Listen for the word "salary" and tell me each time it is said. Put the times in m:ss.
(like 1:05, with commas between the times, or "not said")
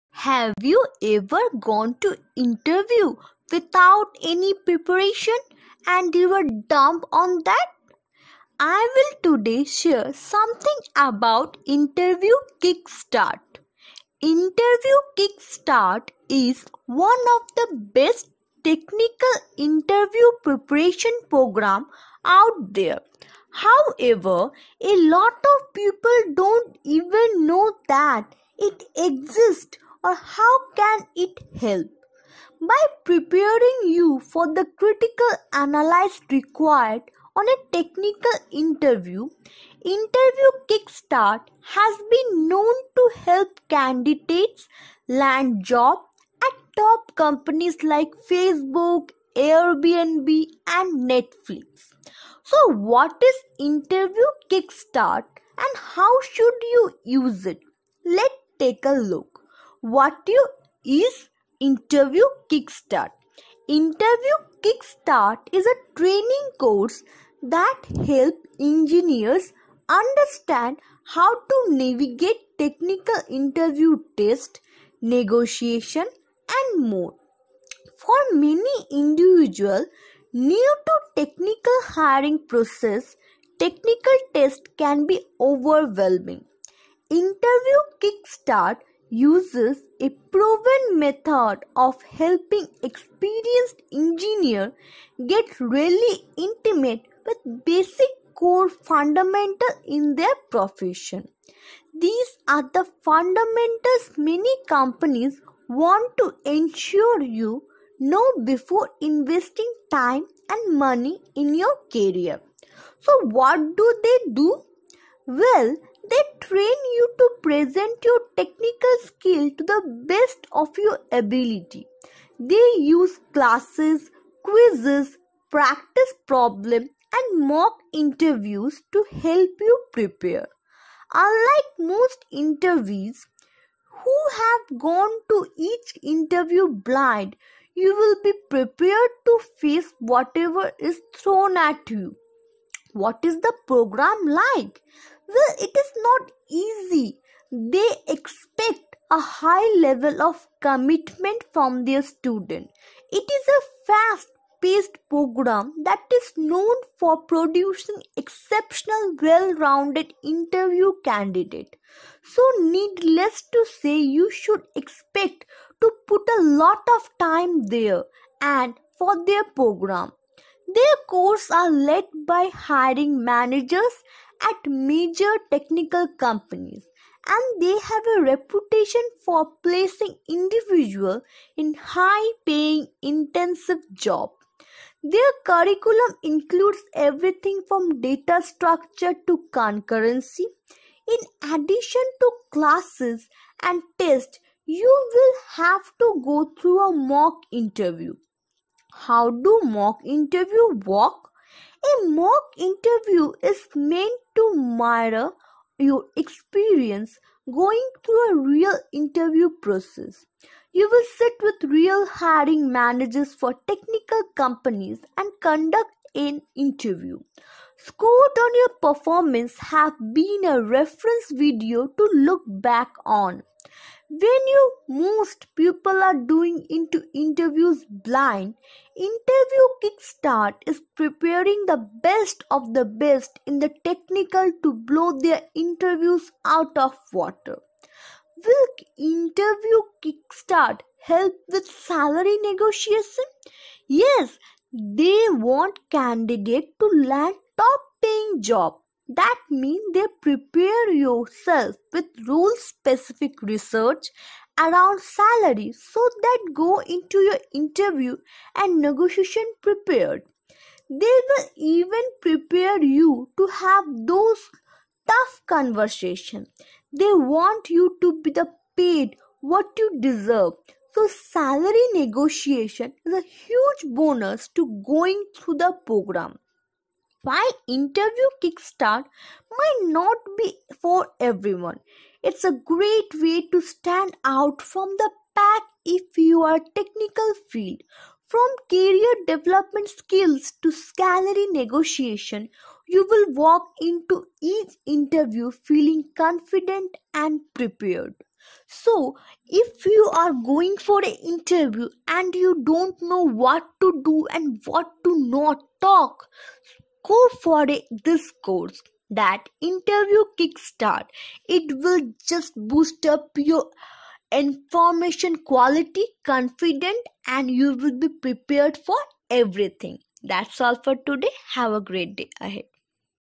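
4:01, 4:15, 4:31, 4:50.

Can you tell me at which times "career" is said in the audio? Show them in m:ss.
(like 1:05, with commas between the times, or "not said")
1:51, 4:48.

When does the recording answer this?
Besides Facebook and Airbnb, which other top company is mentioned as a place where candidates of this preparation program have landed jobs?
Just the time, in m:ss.
0:51.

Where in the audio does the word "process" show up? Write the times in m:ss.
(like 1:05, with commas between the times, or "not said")
1:22, 3:29.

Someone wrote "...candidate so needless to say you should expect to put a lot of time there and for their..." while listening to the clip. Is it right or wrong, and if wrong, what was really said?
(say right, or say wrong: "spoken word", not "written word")
right.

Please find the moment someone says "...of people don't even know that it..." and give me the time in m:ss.
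0:25.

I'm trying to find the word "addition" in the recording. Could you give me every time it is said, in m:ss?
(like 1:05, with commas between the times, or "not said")
3:11.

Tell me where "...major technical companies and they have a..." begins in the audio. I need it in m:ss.
2:54.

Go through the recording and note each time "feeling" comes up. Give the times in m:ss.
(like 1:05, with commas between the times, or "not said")
4:55.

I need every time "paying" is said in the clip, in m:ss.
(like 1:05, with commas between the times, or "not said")
3:02, 4:08.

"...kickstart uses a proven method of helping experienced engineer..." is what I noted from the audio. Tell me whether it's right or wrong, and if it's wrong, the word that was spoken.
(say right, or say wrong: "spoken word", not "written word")
right.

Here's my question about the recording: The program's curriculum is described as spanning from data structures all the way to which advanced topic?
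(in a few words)
concurrency.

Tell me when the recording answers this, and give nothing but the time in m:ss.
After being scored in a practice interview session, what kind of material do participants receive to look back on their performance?
3:40.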